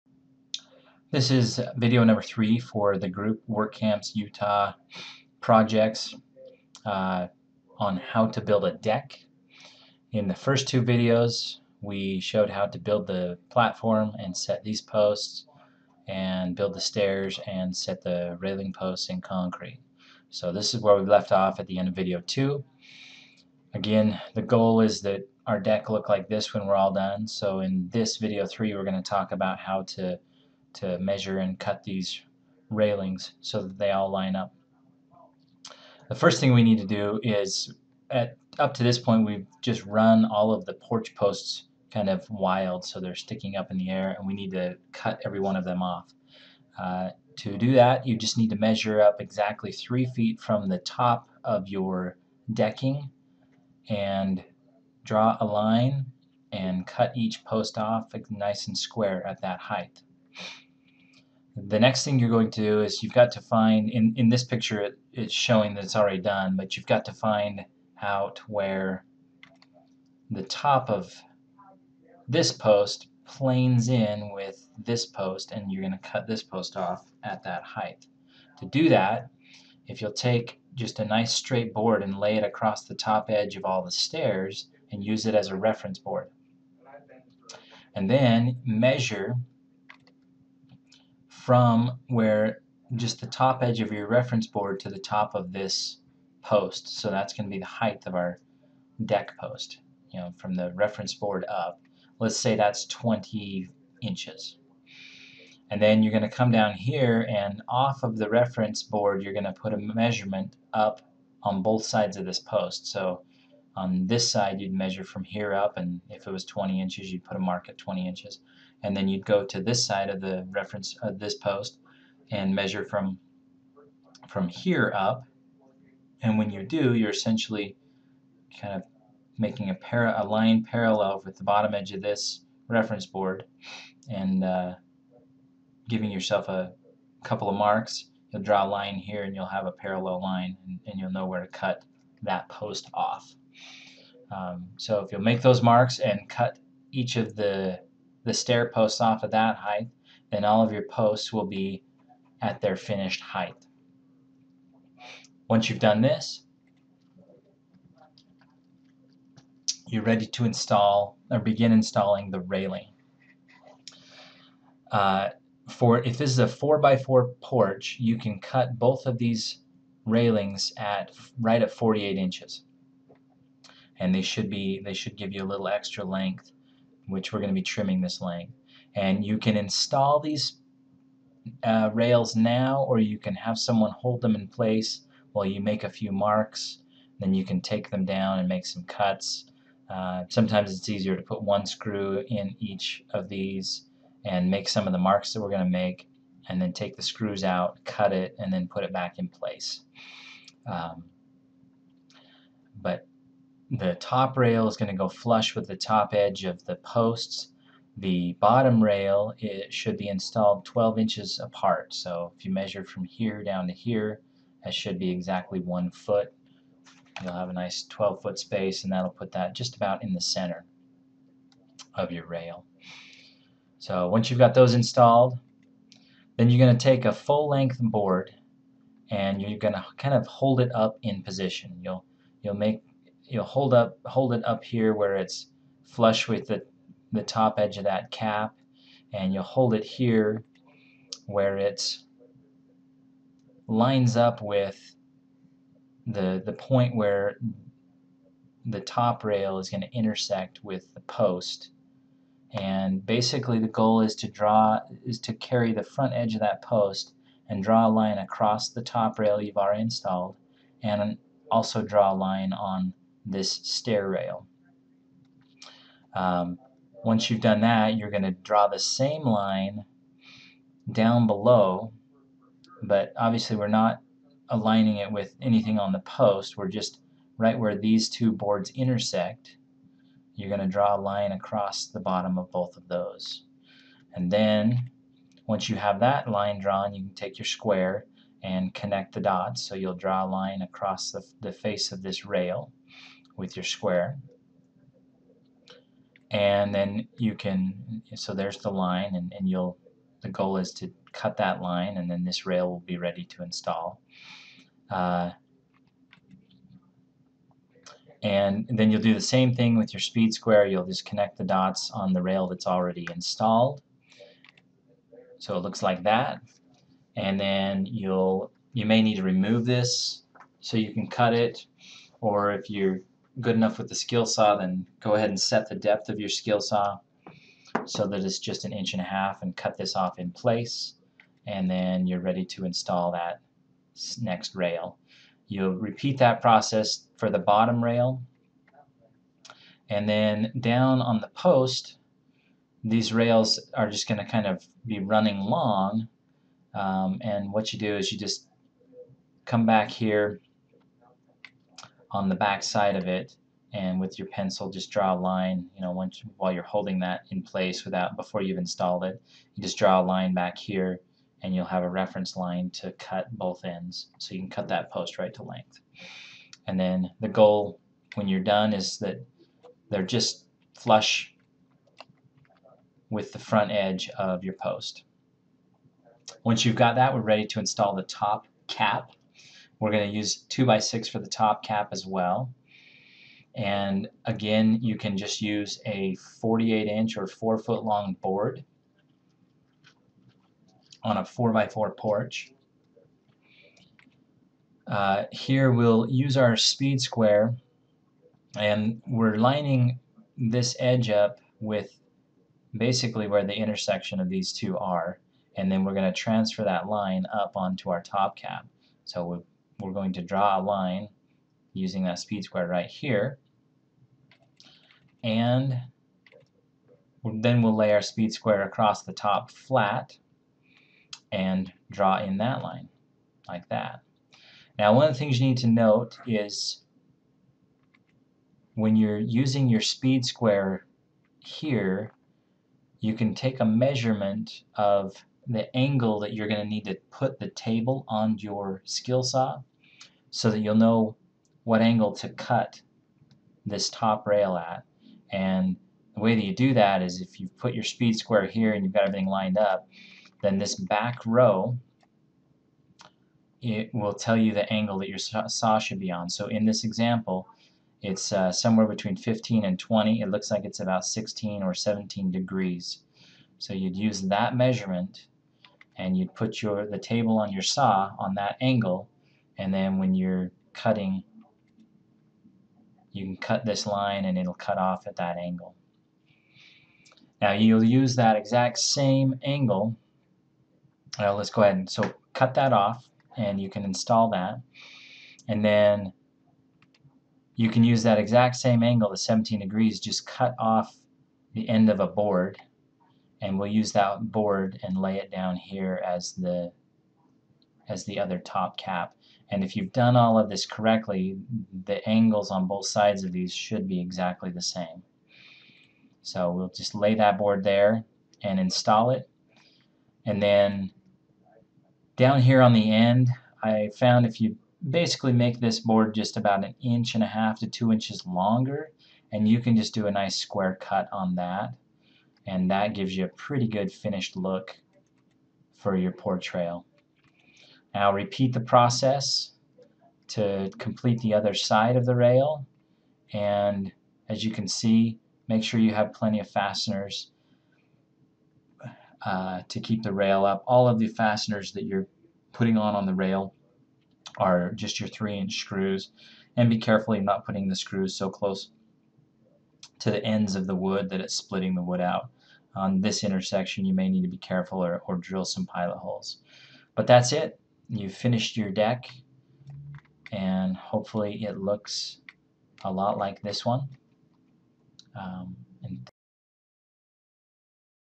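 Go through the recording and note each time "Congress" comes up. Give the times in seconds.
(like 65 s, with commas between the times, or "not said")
not said.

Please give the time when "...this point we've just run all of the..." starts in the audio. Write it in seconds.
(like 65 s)
38 s.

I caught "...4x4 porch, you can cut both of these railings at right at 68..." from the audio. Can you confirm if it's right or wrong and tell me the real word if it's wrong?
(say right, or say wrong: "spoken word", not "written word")
wrong: "48", not "68".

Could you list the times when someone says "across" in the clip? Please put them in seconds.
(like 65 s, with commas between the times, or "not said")
82 s, 258 s, 281 s, 290 s, 418 s.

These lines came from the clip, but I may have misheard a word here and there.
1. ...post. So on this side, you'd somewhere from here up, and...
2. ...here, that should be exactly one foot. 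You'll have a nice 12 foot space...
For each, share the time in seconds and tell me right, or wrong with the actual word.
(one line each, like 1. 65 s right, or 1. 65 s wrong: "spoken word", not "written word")
1. 112 s wrong: "measure", not "somewhere"
2. 213 s right.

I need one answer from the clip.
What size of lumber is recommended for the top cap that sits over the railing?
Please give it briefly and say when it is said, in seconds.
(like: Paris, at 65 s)
2 by 6, at 380 s.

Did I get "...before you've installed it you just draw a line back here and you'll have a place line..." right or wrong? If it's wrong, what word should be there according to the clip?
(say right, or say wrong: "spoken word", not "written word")
wrong: "reference", not "place".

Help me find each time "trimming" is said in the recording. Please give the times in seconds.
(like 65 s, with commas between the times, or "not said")
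177 s.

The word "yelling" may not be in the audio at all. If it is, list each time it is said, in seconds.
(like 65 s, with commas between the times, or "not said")
not said.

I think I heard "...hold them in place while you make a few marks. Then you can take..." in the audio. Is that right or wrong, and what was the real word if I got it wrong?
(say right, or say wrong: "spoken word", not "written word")
right.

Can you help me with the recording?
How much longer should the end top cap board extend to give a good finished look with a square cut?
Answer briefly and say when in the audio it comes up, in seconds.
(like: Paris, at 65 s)
1.5 to 2 inches, at 516 s.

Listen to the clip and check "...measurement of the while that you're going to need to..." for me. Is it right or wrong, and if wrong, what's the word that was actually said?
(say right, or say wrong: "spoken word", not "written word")
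wrong: "angle", not "while".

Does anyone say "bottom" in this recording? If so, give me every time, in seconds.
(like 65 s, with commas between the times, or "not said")
131 s, 208 s, 281 s, 337 s.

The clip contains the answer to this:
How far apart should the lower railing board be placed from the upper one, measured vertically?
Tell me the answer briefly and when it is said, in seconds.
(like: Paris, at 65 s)
12 inches, at 210 s.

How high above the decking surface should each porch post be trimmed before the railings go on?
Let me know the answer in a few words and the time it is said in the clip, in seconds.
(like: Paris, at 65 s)
3 feet, at 49 s.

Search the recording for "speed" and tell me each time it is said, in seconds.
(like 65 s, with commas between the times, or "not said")
309 s, 396 s, 412 s, 418 s, 429 s, 447 s.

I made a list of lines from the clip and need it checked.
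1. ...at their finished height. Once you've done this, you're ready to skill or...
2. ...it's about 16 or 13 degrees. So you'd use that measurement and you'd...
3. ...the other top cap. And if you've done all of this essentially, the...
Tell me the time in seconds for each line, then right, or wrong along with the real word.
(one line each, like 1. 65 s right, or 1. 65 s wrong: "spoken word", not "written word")
1. 152 s wrong: "install", not "skill"
2. 460 s wrong: "17", not "13"
3. 498 s wrong: "correctly", not "essentially".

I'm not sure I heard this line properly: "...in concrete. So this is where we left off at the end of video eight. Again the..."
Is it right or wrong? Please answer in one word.
wrong.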